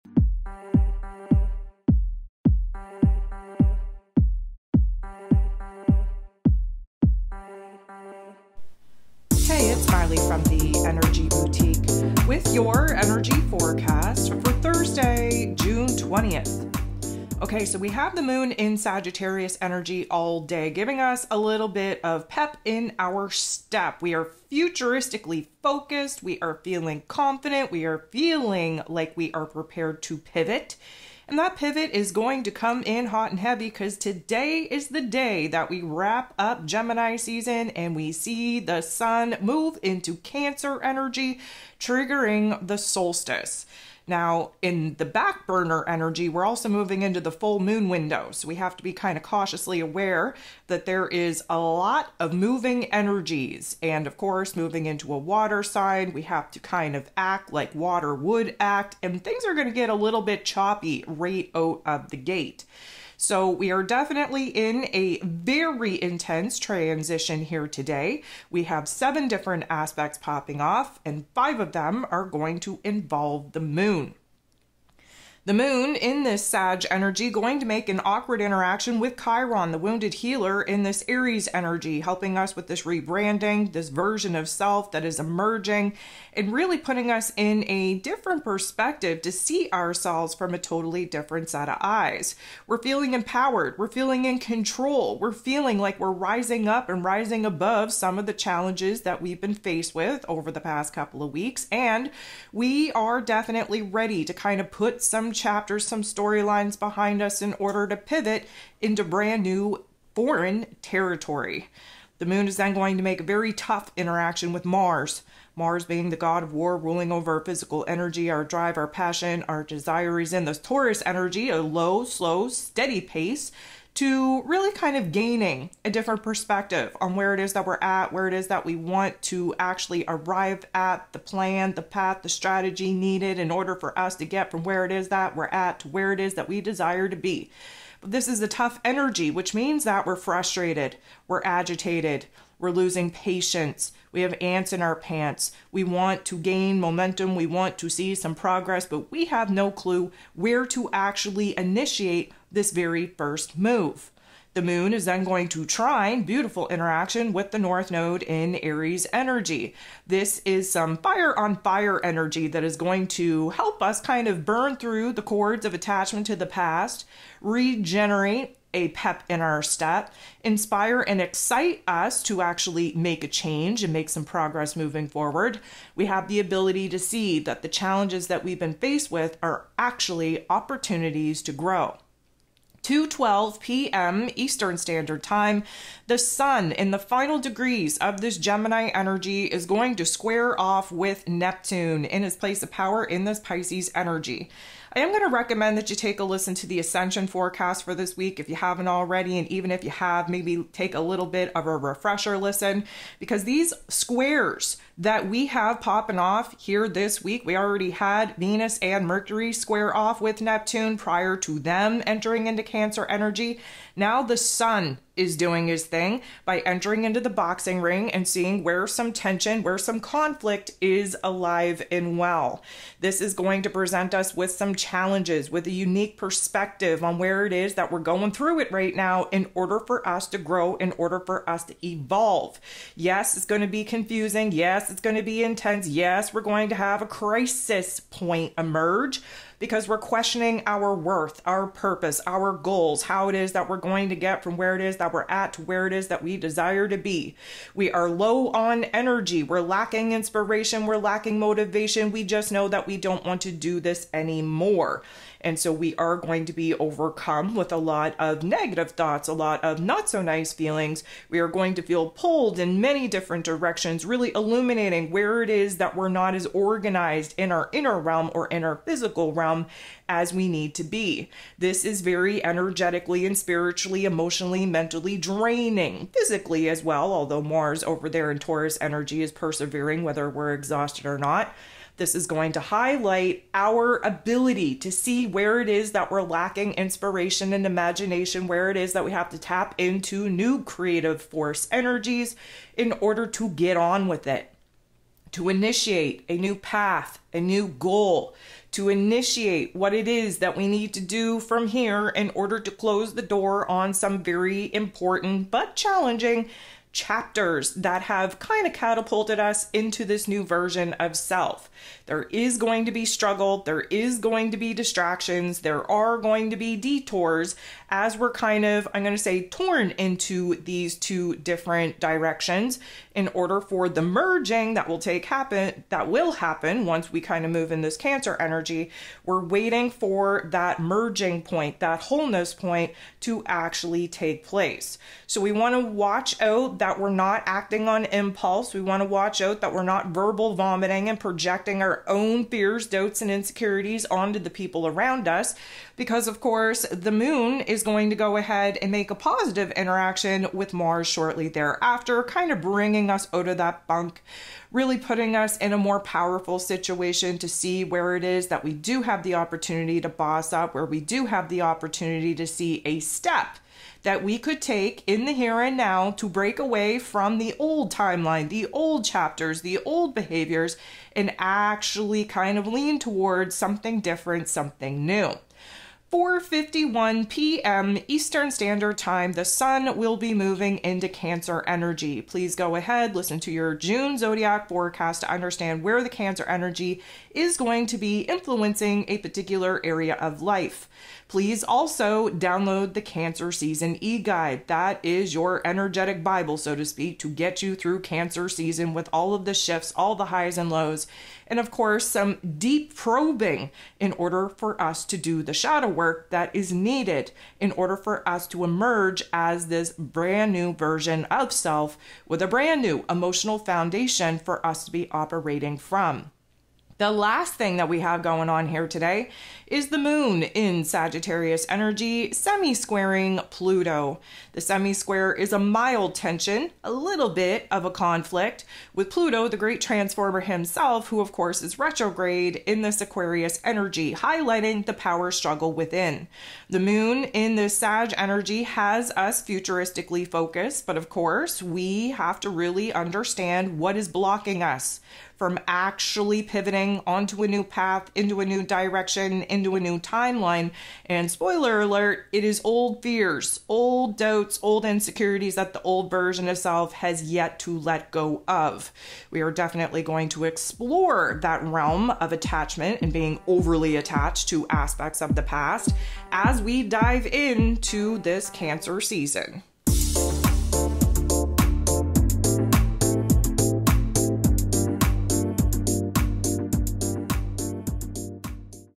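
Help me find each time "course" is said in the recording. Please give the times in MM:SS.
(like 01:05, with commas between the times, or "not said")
00:54, 05:46, 06:41, 07:11, 07:21.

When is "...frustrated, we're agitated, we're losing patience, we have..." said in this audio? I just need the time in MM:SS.
02:20.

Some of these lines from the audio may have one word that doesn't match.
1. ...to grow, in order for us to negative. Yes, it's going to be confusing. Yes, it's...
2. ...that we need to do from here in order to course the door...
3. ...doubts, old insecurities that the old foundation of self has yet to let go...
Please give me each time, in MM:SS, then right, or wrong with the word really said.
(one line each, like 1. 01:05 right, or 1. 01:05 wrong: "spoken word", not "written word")
1. 03:50 wrong: "evolve", not "negative"
2. 05:00 wrong: "close", not "course"
3. 07:34 wrong: "version", not "foundation".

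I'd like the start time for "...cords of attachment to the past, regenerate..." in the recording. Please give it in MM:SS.
02:45.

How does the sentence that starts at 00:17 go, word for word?
Okay, so we have the moon in Sagittarius energy all day, giving us a little bit of pep in our step.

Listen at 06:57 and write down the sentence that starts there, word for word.
The last thing that we have going on here today is the moon in Sagittarius energy semi squaring Pluto.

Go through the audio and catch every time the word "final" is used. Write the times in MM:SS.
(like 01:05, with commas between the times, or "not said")
03:06.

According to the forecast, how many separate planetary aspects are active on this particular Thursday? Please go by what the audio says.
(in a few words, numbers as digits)
7.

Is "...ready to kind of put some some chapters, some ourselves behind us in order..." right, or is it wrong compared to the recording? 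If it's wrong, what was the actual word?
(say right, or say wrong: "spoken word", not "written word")
wrong: "storylines", not "ourselves".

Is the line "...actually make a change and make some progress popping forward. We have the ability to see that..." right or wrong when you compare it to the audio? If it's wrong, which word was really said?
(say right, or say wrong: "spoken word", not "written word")
wrong: "moving", not "popping".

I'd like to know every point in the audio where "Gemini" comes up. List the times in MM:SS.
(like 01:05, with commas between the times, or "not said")
00:36, 03:08.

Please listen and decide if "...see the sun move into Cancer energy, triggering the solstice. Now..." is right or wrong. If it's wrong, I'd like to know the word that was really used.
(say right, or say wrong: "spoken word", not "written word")
right.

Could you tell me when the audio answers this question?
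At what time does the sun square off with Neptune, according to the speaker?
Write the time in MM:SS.
03:02.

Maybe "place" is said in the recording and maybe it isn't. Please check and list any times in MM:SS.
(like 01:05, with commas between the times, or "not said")
03:12, 05:34.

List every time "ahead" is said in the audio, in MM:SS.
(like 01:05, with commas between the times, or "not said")
05:48, 06:22.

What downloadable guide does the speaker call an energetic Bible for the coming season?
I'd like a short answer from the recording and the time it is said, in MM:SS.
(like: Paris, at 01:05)
Cancer Season e guide, at 06:33.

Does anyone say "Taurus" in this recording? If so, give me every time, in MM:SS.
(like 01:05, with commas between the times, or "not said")
02:00, 04:38.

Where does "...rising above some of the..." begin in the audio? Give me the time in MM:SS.
01:37.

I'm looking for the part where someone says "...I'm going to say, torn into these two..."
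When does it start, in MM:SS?
05:18.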